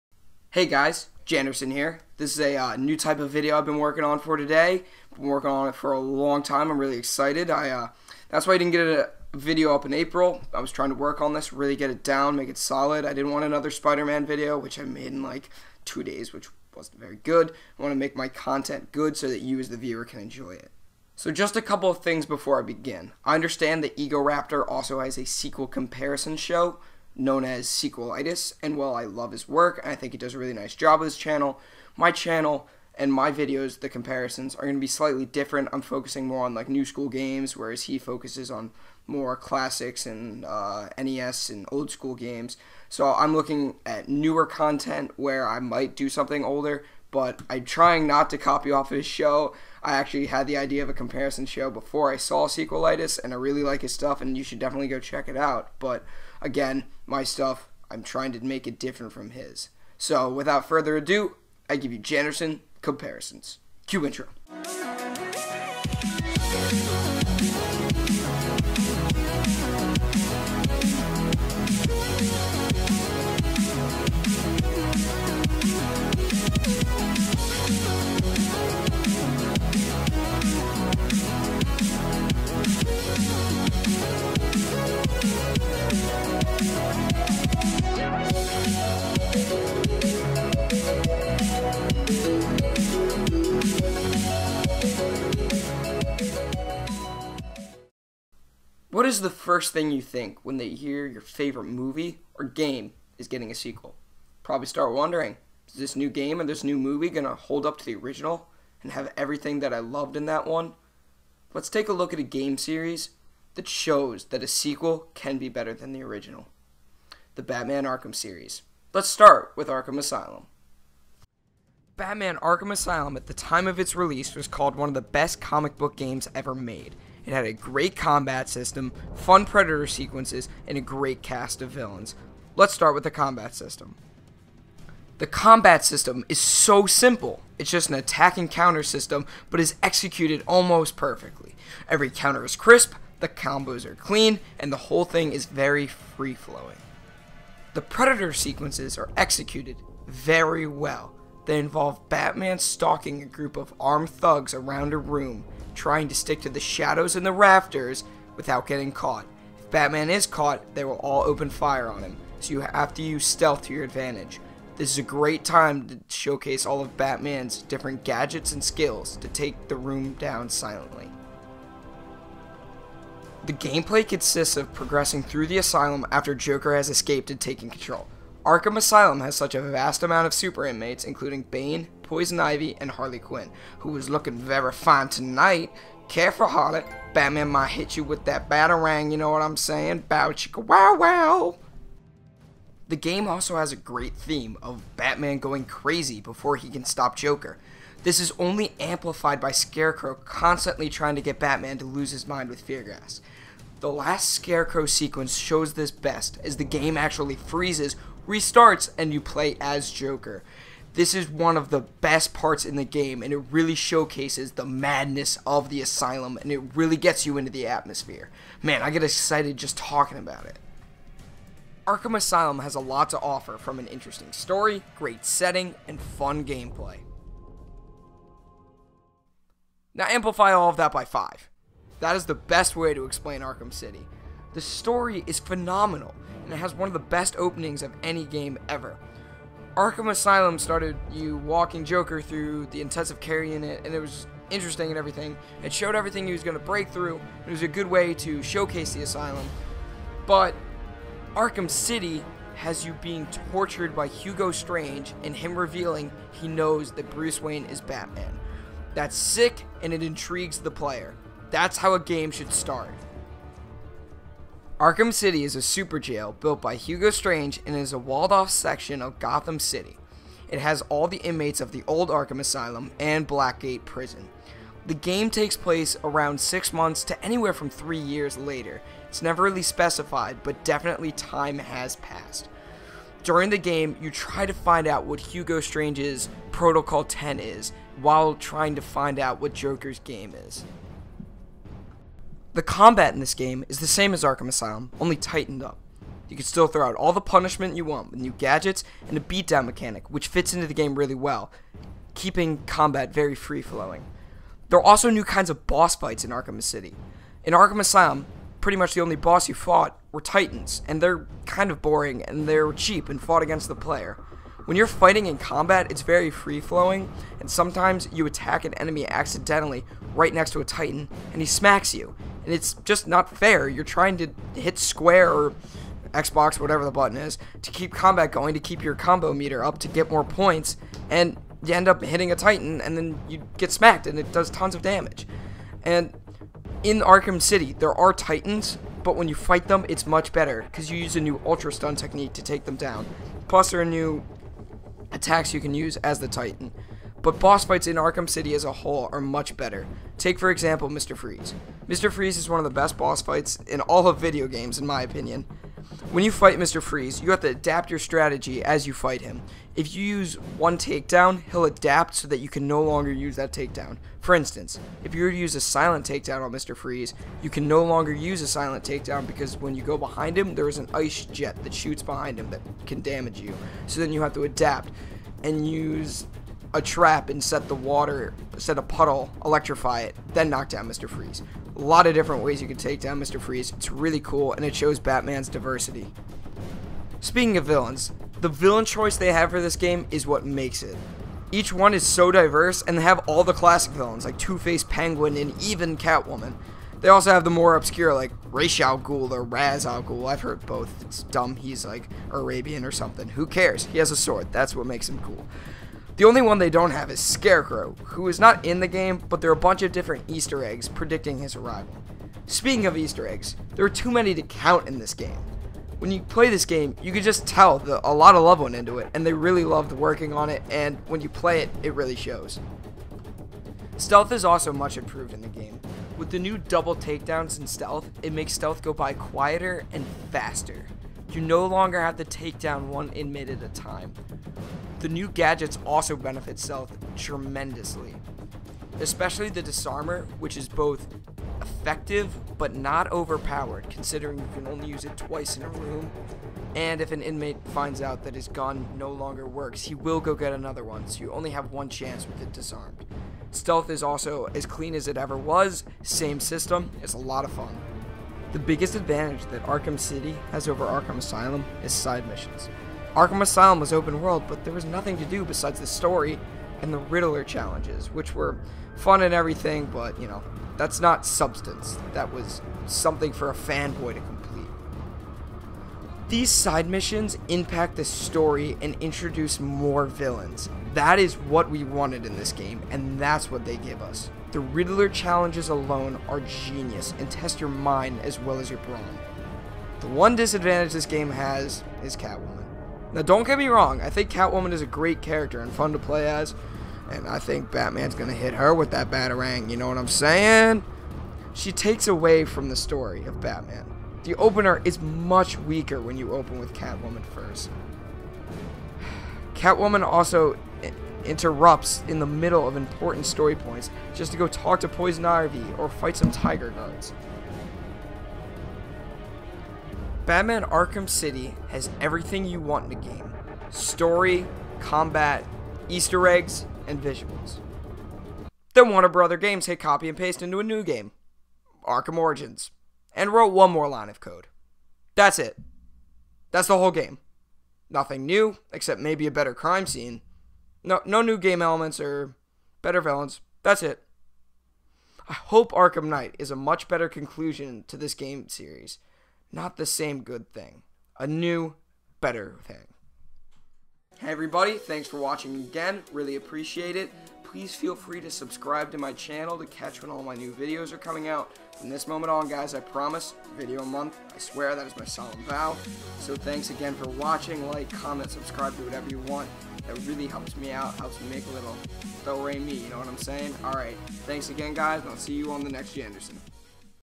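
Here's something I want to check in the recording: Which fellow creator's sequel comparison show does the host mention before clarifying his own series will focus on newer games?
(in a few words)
Egoraptor.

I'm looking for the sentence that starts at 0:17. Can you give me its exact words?
I want to make my content good so that you as the viewer can enjoy it.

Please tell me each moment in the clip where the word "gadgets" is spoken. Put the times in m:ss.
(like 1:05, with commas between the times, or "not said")
2:48, 4:58, 7:15.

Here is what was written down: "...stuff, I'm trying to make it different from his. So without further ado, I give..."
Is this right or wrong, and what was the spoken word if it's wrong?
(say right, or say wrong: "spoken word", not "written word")
right.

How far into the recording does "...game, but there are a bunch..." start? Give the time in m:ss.
6:48.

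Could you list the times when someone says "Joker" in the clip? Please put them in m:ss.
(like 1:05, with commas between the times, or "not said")
2:56, 3:17, 3:29, 4:01, 4:49.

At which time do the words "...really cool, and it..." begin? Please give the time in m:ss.
6:23.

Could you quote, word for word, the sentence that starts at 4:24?
Arkham City is a super jail built by Hugo Strange and is a walled off section of Gotham City.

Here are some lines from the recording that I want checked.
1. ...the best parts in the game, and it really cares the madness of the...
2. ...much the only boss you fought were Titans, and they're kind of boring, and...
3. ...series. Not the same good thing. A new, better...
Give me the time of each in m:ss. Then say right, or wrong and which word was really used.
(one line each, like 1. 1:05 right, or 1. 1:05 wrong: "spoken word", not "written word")
1. 3:31 wrong: "showcases", not "cares"
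2. 5:08 right
3. 9:08 right.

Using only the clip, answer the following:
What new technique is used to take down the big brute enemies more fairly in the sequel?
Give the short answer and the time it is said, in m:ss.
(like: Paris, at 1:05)
Ultra Stun, at 5:41.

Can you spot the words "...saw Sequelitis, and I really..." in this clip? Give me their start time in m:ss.
0:52.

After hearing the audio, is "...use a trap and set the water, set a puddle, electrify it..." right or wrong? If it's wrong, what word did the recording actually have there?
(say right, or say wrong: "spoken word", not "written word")
right.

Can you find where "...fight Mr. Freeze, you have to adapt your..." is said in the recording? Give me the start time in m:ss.
5:56.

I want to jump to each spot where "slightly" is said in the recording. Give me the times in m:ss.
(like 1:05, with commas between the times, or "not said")
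0:34.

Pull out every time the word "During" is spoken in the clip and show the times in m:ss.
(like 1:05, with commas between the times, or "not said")
4:43.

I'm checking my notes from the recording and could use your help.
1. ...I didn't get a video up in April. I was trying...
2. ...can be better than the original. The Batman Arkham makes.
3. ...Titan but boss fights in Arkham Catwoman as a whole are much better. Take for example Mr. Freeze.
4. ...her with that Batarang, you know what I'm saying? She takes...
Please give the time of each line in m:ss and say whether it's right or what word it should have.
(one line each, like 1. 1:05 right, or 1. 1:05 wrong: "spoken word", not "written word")
1. 0:08 right
2. 1:55 wrong: "series", not "makes"
3. 5:46 wrong: "City", not "Catwoman"
4. 8:18 right.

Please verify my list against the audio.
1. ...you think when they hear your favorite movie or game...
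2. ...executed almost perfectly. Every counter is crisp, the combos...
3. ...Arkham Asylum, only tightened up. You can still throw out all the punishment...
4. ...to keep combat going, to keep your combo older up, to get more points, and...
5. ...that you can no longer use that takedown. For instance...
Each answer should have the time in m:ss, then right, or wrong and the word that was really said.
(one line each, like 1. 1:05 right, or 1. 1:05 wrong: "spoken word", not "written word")
1. 1:39 right
2. 2:19 right
3. 4:54 right
4. 5:27 wrong: "meter", not "older"
5. 6:02 right.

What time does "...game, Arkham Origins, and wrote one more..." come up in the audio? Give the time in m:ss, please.
8:50.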